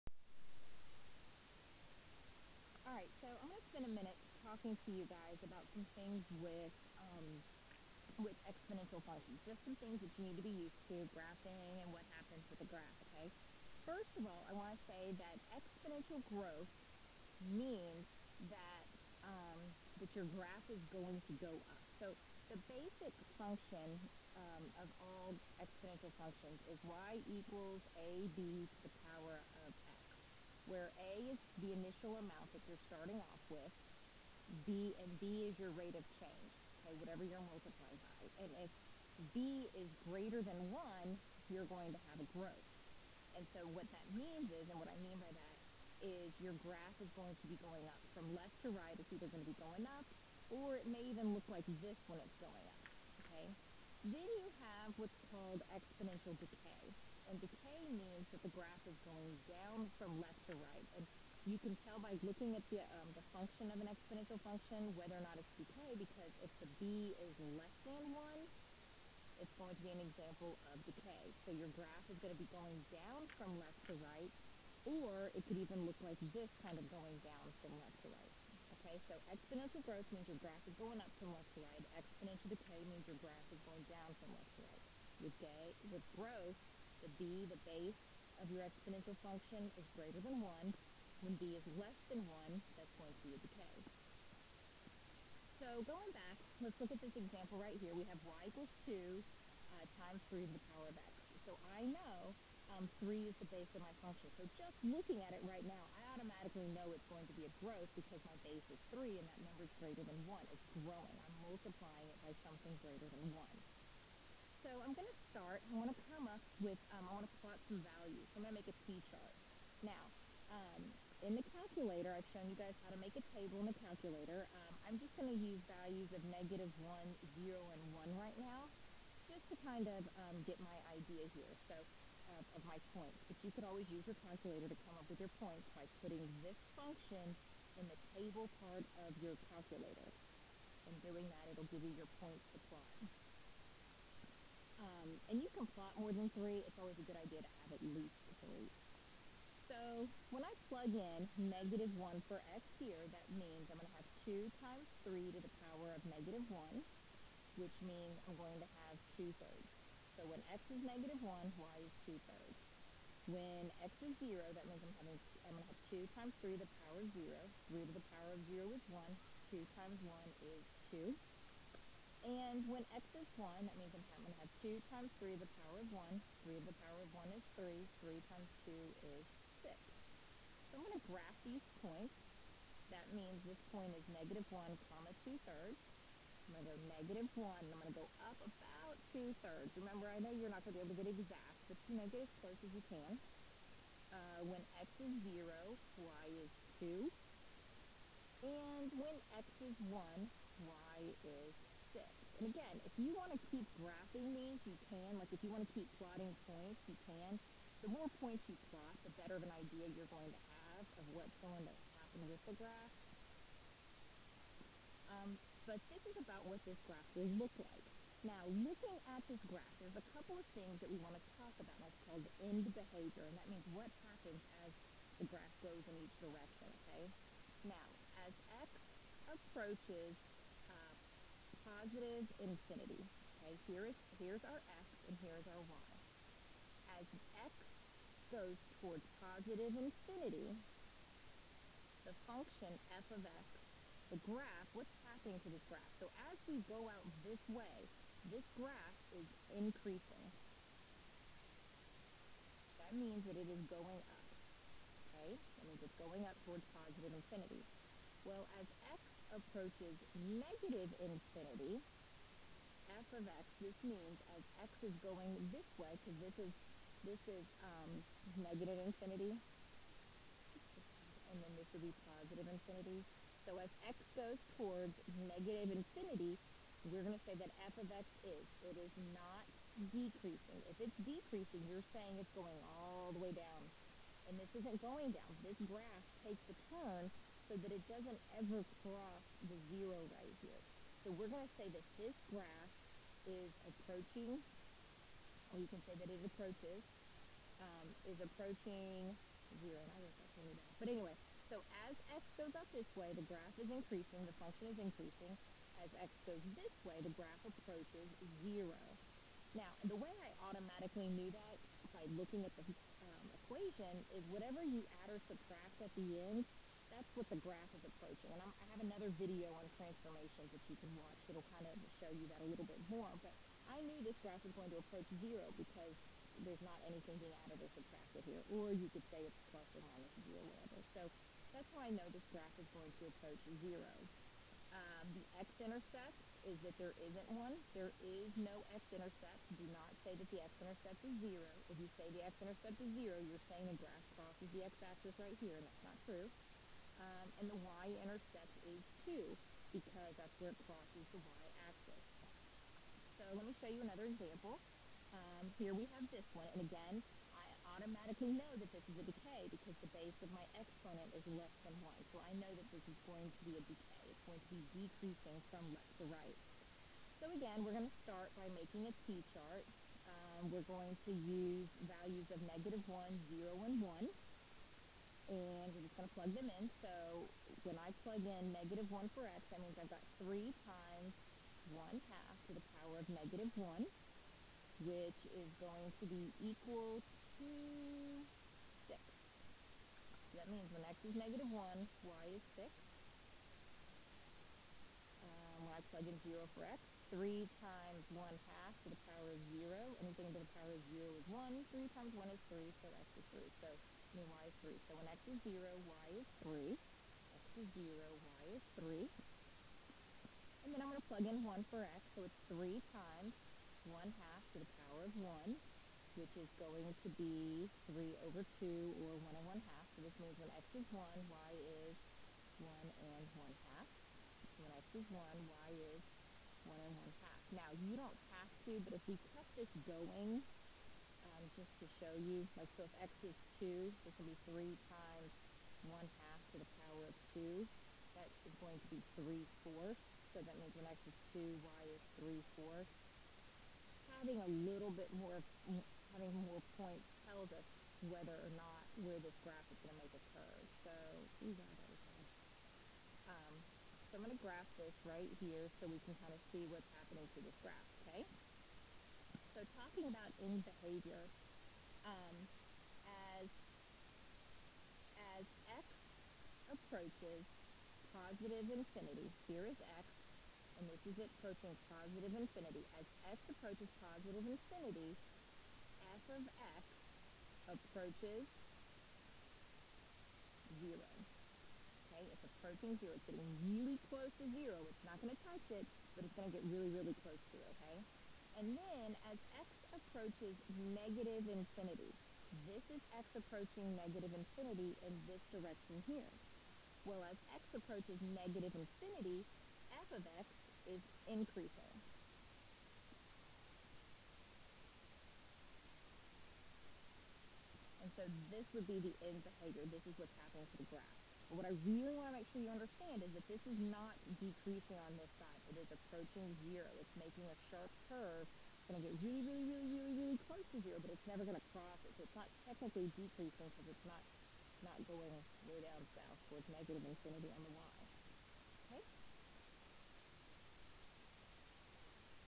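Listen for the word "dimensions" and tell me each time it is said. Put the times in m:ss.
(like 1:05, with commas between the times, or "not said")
not said.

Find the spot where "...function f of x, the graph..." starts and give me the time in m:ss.
4:02.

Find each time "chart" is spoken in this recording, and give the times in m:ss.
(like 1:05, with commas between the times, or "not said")
1:58, 6:09.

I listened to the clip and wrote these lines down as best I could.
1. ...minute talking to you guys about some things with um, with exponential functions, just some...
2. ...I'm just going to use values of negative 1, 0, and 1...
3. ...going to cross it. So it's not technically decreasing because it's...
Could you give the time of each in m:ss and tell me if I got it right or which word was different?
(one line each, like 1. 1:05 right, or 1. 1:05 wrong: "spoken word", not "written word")
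1. 0:03 right
2. 2:04 right
3. 8:41 right.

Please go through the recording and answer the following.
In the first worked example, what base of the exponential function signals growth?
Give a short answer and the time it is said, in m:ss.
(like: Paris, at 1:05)
3, at 1:43.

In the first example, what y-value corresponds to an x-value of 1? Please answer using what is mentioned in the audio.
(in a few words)
6.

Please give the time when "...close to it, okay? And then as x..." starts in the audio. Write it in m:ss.
8:07.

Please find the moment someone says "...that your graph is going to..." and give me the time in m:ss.
0:20.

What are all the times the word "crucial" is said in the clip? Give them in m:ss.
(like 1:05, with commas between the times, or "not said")
not said.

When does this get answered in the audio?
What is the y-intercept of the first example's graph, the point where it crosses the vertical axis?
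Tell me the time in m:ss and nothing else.
5:47.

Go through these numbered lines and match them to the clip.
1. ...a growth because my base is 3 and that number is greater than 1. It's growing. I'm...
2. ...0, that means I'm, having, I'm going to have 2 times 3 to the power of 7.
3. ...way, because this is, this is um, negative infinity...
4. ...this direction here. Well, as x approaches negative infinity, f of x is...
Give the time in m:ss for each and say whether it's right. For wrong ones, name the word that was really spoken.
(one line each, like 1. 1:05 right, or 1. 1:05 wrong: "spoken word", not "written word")
1. 1:47 right
2. 2:44 wrong: "0", not "7"
3. 4:25 right
4. 8:15 right.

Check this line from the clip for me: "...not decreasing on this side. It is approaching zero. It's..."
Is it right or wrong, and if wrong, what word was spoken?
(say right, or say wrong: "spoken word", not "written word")
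right.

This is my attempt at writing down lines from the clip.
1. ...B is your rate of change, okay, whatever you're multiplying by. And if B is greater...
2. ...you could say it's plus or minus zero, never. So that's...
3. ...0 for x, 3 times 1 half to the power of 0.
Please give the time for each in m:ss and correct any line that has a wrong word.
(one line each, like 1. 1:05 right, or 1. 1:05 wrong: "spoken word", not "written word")
1. 0:35 right
2. 5:28 wrong: "whatever", not "never"
3. 6:36 right.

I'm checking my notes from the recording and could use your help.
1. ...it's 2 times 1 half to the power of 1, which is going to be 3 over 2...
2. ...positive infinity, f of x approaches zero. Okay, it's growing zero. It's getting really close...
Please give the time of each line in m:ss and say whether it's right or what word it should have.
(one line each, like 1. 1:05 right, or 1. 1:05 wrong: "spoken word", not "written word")
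1. 6:52 wrong: "3", not "2"
2. 7:54 wrong: "approaching", not "growing".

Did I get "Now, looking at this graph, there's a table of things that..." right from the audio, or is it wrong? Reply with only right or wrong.
wrong.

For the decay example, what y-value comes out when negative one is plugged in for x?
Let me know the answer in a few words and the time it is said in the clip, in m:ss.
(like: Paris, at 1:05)
6, at 6:26.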